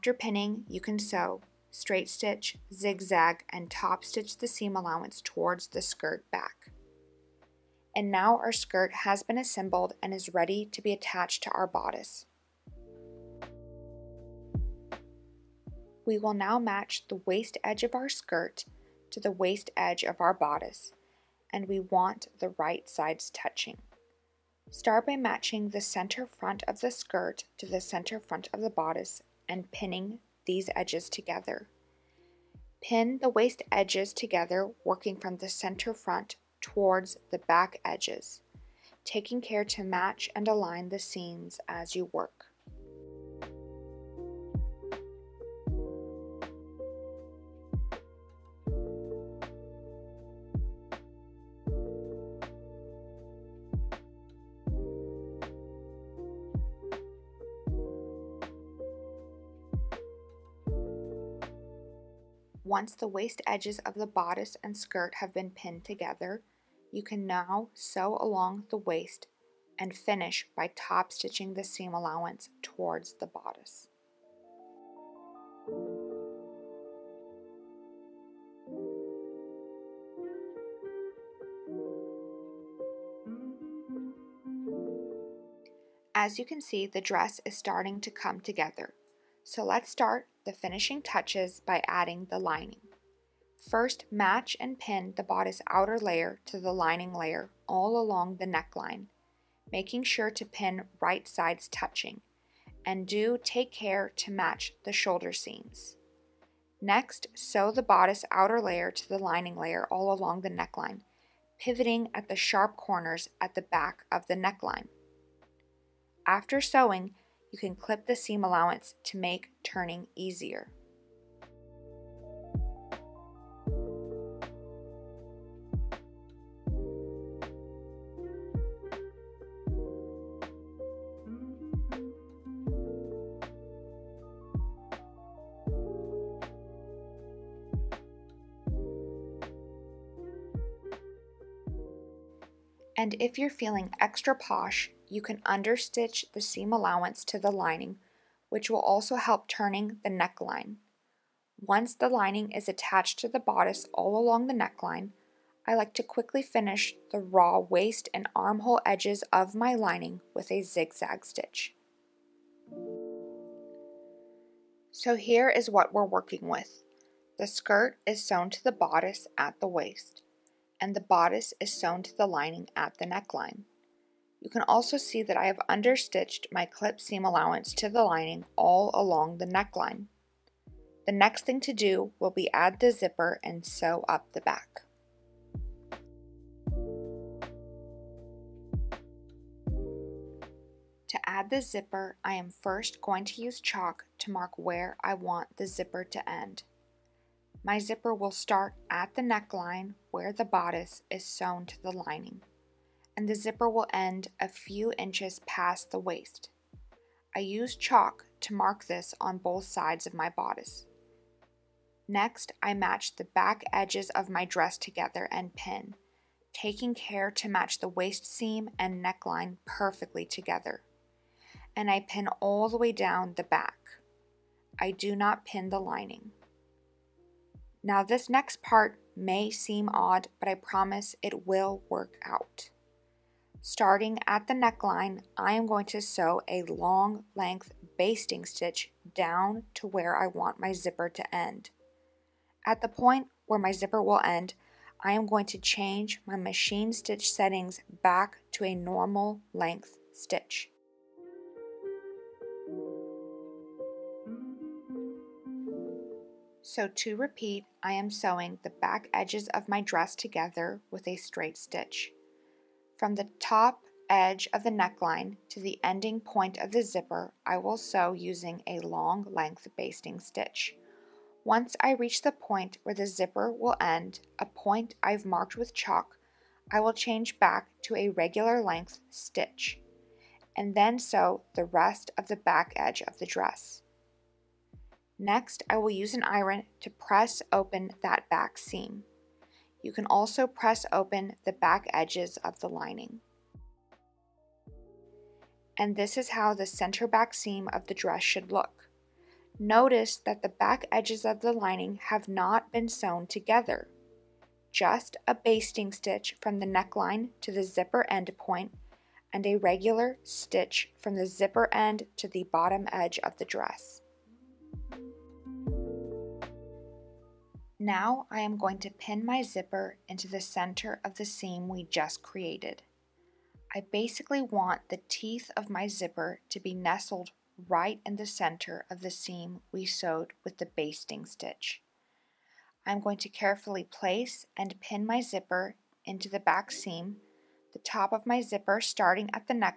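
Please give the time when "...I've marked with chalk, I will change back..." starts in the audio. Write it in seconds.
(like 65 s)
275 s.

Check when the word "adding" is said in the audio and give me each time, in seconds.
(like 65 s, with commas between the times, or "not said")
91 s.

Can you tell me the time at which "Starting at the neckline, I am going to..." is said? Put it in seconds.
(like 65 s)
233 s.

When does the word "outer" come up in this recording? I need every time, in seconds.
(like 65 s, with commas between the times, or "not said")
95 s, 108 s.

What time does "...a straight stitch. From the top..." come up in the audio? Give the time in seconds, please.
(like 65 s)
261 s.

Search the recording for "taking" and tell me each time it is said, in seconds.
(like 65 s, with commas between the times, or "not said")
39 s, 216 s.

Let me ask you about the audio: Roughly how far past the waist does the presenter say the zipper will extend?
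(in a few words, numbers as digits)
a few inches.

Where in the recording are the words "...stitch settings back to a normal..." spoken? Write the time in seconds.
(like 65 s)
246 s.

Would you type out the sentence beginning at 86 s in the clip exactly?
As you can see, the dress is starting to come together.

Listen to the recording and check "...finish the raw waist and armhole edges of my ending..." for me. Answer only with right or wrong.
wrong.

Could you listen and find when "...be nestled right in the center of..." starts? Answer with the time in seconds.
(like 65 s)
326 s.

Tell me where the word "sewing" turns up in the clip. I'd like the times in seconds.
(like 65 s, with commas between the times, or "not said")
116 s, 258 s.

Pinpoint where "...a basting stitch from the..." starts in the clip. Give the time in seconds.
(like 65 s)
305 s.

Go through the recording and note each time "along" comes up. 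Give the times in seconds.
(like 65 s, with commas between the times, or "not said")
68 s, 97 s, 110 s, 154 s, 178 s.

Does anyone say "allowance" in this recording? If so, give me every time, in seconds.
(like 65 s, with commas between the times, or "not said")
4 s, 71 s, 118 s, 146 s, 177 s.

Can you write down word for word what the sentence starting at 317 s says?
Now I am going to pin my zipper into the center of the seam we just created.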